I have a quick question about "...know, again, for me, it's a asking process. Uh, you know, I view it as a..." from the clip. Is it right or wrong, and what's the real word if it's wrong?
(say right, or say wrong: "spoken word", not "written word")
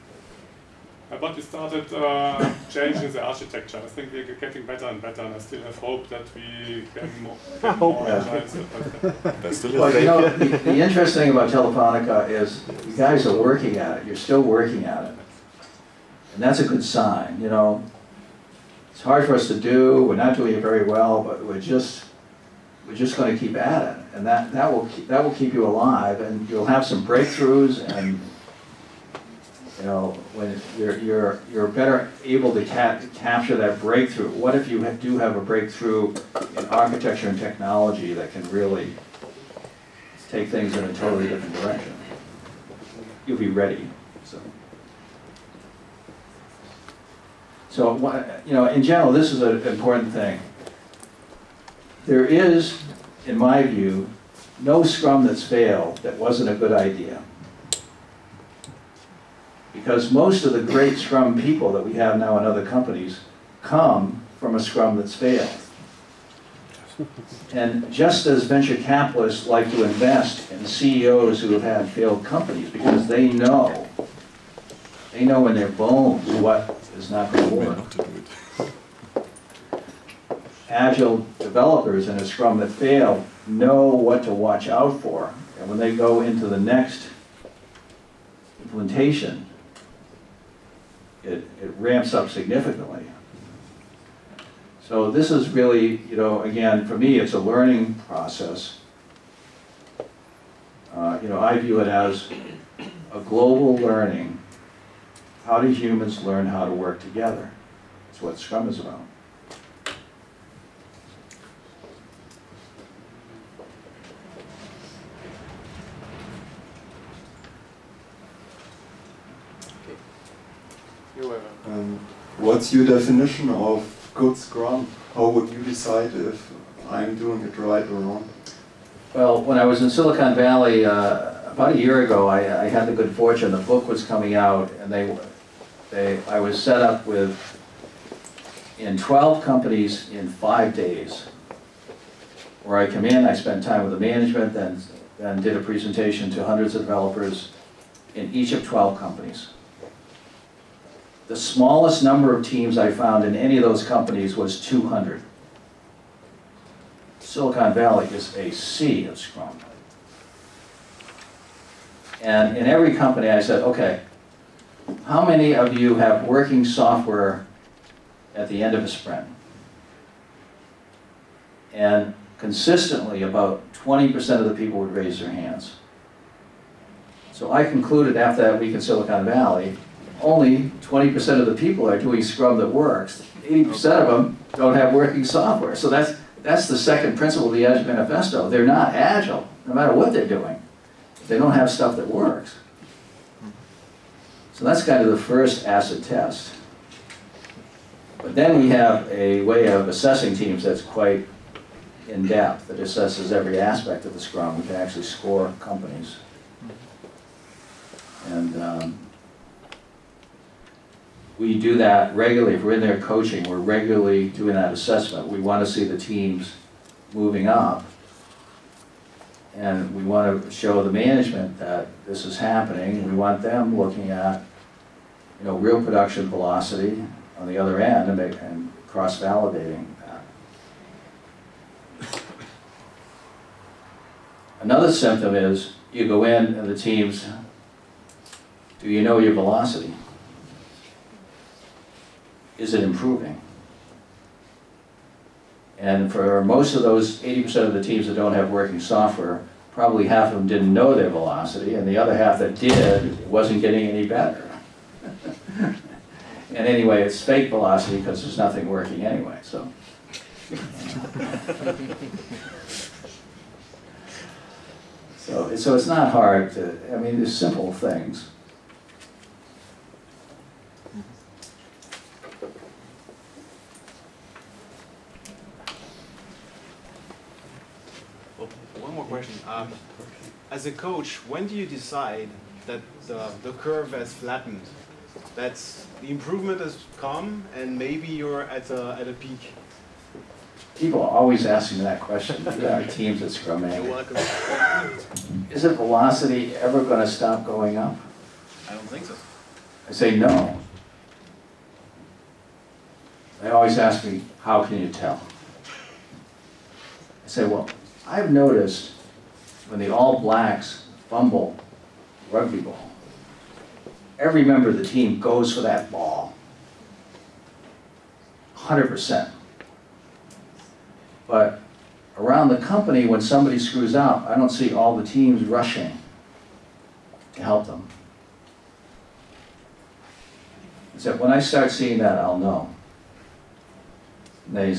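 wrong: "learning", not "asking".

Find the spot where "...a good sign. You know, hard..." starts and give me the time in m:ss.
0:16.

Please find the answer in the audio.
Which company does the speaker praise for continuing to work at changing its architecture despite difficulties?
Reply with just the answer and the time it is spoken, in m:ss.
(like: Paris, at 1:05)
Telefonica, at 0:11.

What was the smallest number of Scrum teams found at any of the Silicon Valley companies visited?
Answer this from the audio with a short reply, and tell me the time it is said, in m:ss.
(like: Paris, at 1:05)
200, at 2:34.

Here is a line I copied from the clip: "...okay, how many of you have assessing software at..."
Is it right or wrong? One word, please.
wrong.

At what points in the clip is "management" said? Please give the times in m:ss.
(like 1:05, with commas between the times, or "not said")
2:23, 3:40.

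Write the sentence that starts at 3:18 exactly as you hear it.
But then we have a way of assessing teams that's quite in-depth, that assesses every aspect of the scrum.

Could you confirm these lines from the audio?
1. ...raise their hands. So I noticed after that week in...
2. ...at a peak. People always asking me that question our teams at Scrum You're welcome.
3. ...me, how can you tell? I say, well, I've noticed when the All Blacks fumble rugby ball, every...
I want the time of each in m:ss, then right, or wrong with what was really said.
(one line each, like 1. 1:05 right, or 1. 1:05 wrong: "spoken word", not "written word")
1. 2:54 wrong: "concluded", not "noticed"
2. 4:48 right
3. 5:04 right.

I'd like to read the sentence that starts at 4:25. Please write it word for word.
so, so it's not hard to, I mean, there's simple things.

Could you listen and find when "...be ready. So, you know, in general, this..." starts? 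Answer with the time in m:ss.
0:43.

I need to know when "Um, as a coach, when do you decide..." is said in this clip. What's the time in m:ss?
4:39.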